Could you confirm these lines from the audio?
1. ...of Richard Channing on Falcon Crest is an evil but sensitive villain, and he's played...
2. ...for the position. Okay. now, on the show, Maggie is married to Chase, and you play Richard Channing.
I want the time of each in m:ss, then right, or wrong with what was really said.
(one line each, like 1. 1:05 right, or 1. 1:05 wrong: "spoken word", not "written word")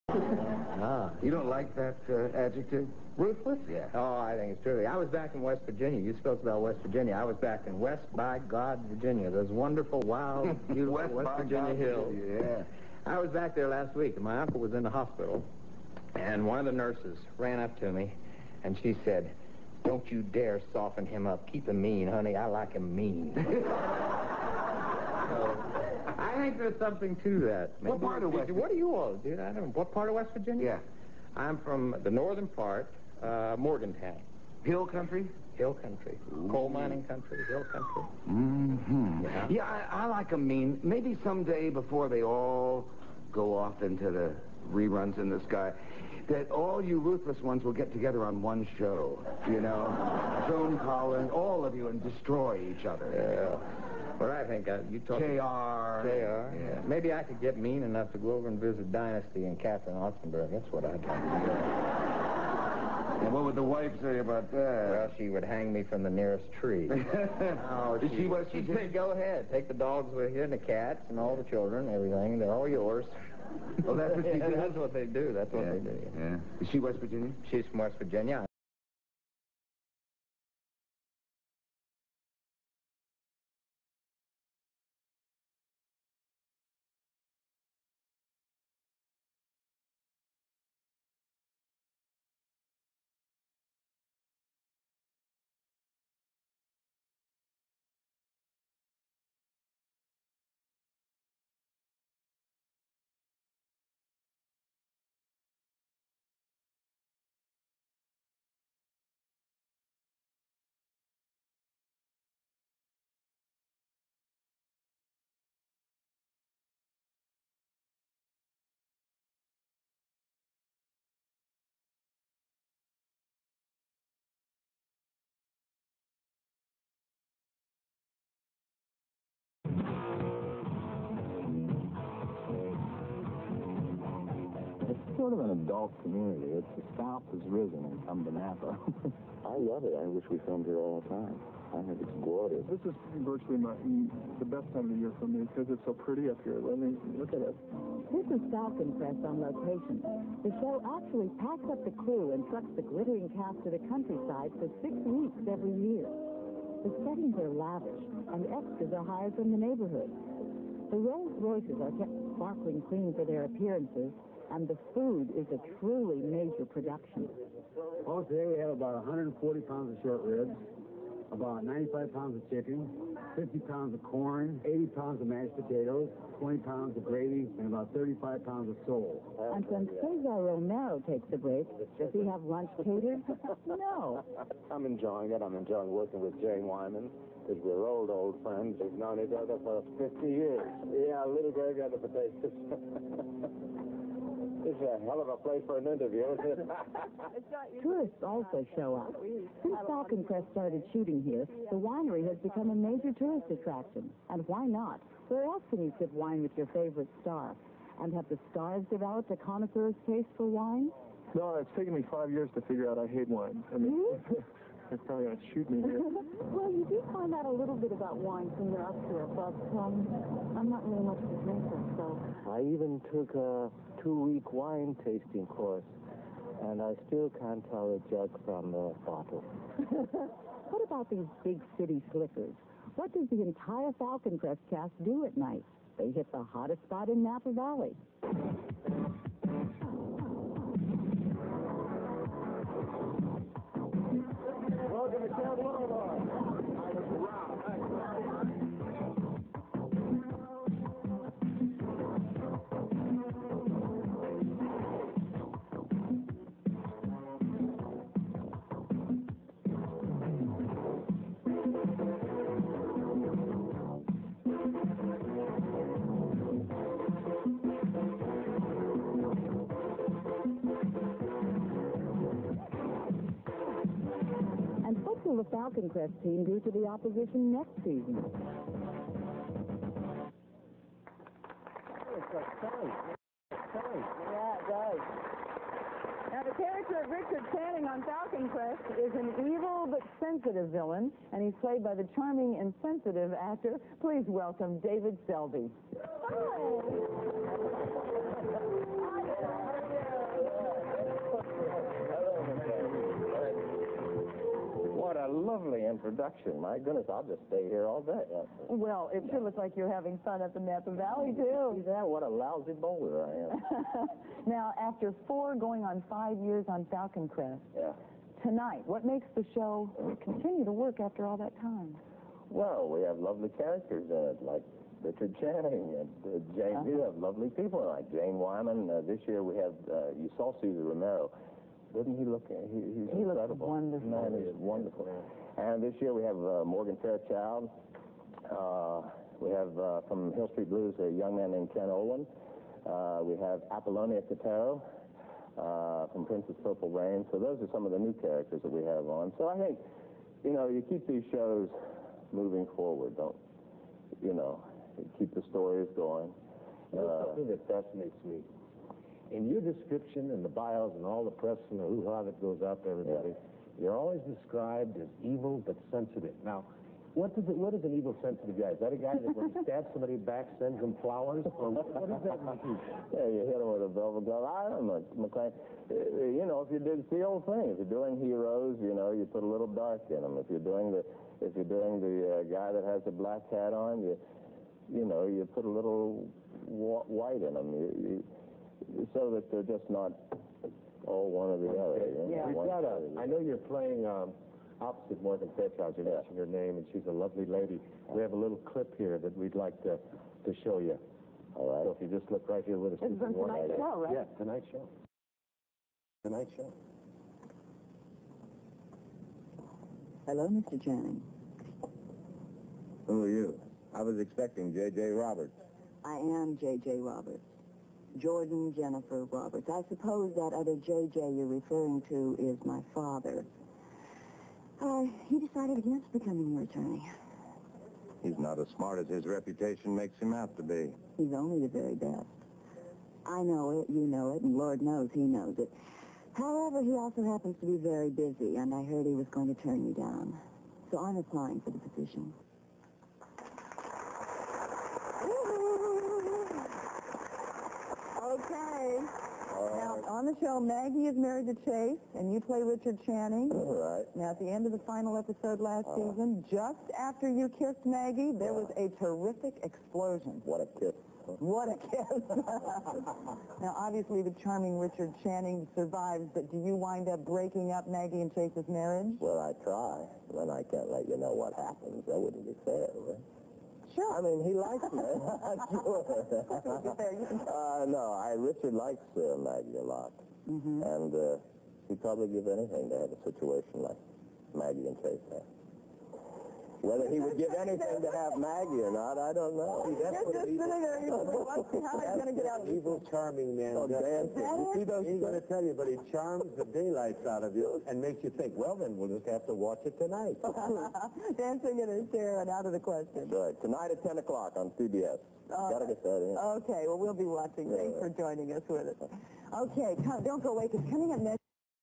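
1. 4:47 right
2. 7:21 right.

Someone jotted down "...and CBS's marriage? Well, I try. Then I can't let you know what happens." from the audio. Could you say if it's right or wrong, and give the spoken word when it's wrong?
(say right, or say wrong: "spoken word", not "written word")
wrong: "Chase", not "CBS".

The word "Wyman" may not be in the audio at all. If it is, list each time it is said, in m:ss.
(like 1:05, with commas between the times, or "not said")
3:06, 5:28.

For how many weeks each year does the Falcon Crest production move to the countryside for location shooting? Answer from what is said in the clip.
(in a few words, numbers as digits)
6.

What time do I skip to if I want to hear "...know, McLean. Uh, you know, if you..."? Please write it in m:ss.
6:14.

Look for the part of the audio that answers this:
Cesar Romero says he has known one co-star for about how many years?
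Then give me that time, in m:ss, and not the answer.
3:09.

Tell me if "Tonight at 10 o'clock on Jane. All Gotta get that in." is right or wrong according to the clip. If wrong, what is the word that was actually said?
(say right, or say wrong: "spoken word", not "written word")
wrong: "CBS", not "Jane".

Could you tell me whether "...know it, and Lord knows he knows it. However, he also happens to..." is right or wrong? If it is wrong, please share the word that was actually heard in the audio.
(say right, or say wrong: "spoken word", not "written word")
right.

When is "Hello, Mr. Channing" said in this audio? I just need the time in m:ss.
6:50.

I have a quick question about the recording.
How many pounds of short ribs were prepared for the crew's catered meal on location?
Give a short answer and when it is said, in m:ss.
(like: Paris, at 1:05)
140, at 2:49.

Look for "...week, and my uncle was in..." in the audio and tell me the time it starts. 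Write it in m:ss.
0:13.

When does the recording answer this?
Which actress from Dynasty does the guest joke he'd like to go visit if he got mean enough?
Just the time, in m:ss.
0:59.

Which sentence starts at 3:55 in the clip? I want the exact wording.
They hit the hottest spot in Napa Valley.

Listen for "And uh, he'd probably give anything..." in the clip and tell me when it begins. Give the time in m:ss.
8:00.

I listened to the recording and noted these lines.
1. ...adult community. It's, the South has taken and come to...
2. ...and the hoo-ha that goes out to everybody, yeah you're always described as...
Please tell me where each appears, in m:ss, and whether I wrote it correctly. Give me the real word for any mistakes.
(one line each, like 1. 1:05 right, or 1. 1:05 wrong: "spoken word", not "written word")
1. 2:15 wrong: "risen", not "taken"
2. 6:01 right.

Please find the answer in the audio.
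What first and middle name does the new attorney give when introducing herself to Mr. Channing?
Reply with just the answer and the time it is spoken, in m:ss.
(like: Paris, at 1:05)
Jordan Jennifer, at 6:58.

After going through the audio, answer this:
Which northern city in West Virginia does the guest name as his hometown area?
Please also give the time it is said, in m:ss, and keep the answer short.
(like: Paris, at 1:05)
Morgantown, at 0:33.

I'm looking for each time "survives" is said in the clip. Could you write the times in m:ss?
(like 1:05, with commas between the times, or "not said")
7:45.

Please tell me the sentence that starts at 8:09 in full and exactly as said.
See, that's You're what just sitting there.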